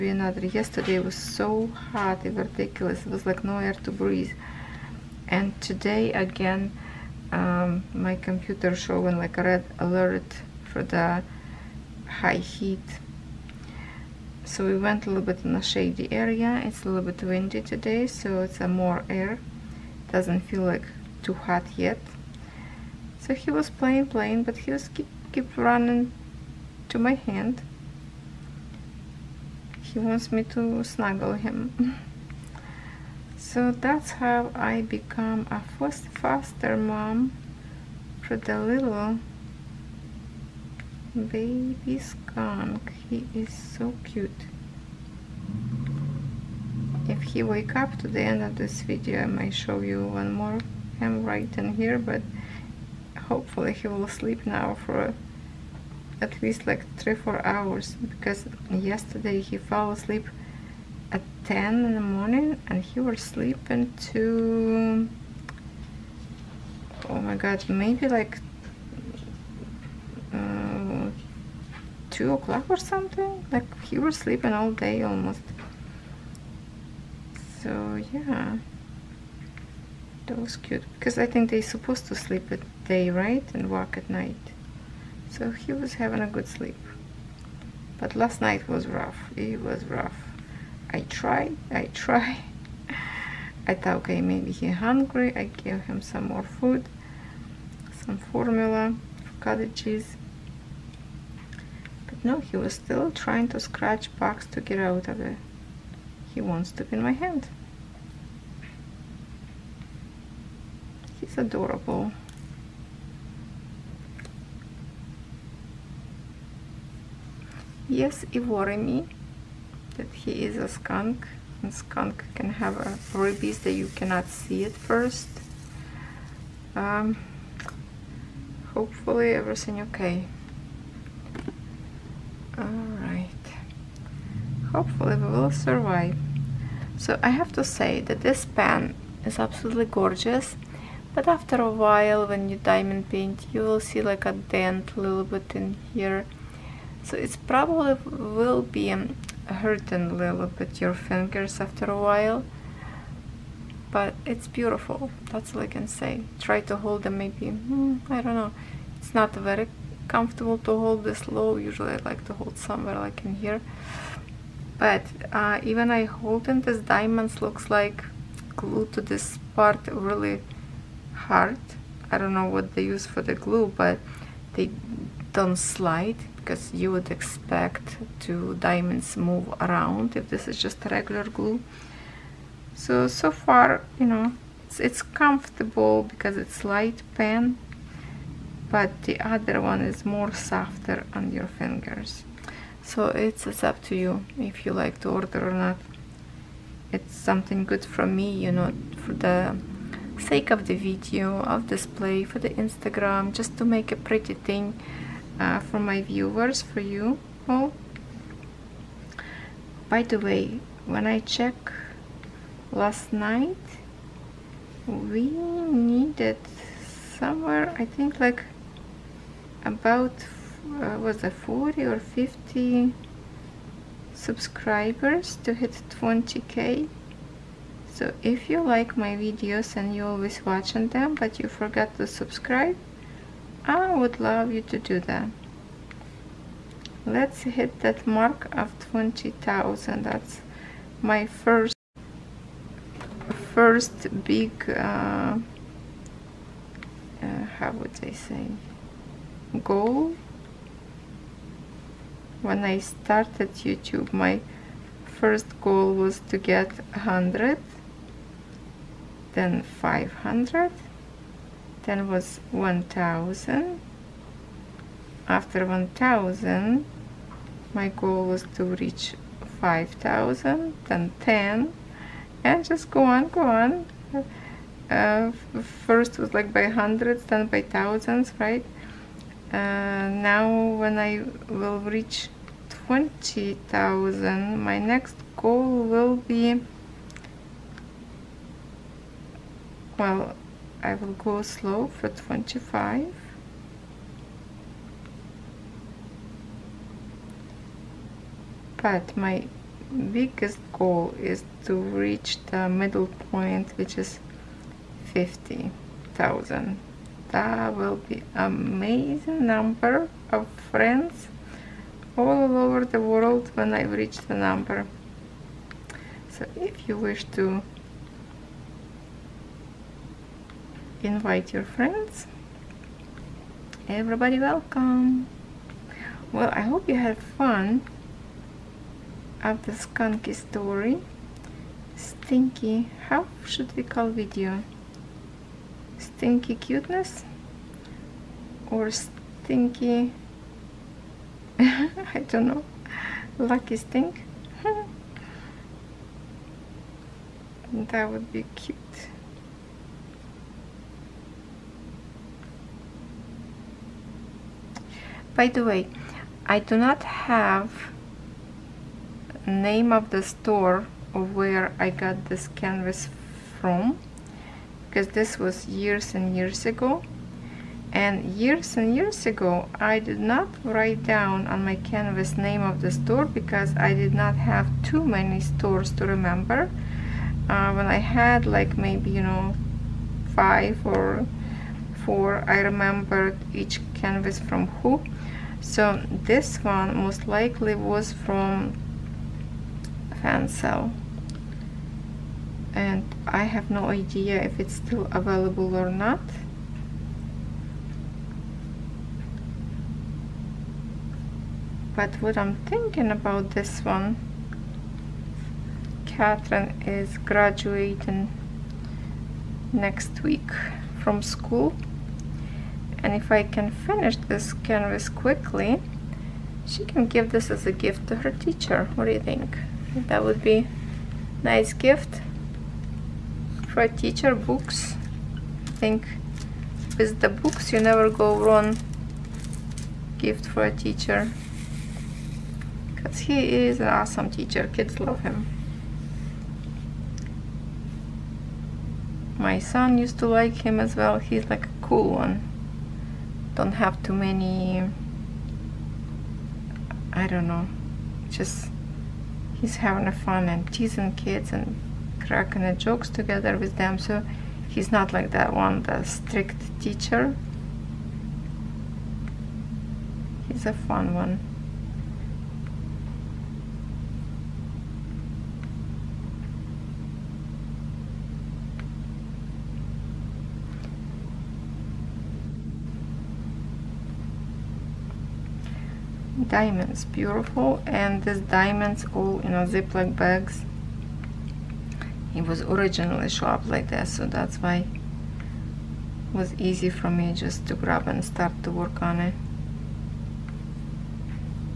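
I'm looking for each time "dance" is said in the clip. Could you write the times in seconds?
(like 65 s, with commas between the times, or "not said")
not said.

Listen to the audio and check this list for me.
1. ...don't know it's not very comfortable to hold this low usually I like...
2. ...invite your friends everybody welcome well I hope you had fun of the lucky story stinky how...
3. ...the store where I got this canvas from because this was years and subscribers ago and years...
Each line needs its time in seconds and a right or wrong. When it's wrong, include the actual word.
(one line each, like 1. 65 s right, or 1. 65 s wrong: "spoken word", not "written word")
1. 158 s right
2. 321 s wrong: "skunky", not "lucky"
3. 360 s wrong: "years", not "subscribers".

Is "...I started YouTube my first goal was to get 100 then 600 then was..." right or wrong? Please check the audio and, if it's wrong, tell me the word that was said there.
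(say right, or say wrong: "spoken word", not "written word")
wrong: "500", not "600".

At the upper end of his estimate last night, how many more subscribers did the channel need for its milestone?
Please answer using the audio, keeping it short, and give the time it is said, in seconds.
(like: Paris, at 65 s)
50, at 221 s.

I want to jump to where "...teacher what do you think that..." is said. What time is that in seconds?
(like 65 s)
418 s.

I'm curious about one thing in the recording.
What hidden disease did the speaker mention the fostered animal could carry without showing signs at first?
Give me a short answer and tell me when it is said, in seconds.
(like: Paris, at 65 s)
Rabies, at 123 s.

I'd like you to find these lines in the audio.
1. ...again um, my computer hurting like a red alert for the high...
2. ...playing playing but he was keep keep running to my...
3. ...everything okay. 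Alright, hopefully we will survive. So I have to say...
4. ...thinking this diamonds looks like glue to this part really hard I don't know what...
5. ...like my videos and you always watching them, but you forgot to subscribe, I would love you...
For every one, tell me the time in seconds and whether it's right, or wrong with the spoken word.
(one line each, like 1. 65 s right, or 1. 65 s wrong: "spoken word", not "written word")
1. 6 s wrong: "showing", not "hurting"
2. 23 s right
3. 129 s right
4. 166 s wrong: "holding", not "thinking"
5. 228 s right.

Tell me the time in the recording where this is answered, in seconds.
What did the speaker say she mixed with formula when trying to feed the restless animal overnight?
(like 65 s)
99 s.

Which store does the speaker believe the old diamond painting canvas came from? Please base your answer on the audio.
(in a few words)
Fansells.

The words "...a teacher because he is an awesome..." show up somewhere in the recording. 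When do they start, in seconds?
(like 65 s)
430 s.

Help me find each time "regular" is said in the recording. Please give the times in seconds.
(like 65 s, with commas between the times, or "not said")
180 s.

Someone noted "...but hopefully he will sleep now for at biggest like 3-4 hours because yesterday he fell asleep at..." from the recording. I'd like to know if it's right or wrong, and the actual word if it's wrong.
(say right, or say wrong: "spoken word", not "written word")
wrong: "least", not "biggest".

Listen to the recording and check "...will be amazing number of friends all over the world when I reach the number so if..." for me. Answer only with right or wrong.
right.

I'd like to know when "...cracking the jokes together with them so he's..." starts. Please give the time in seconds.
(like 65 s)
452 s.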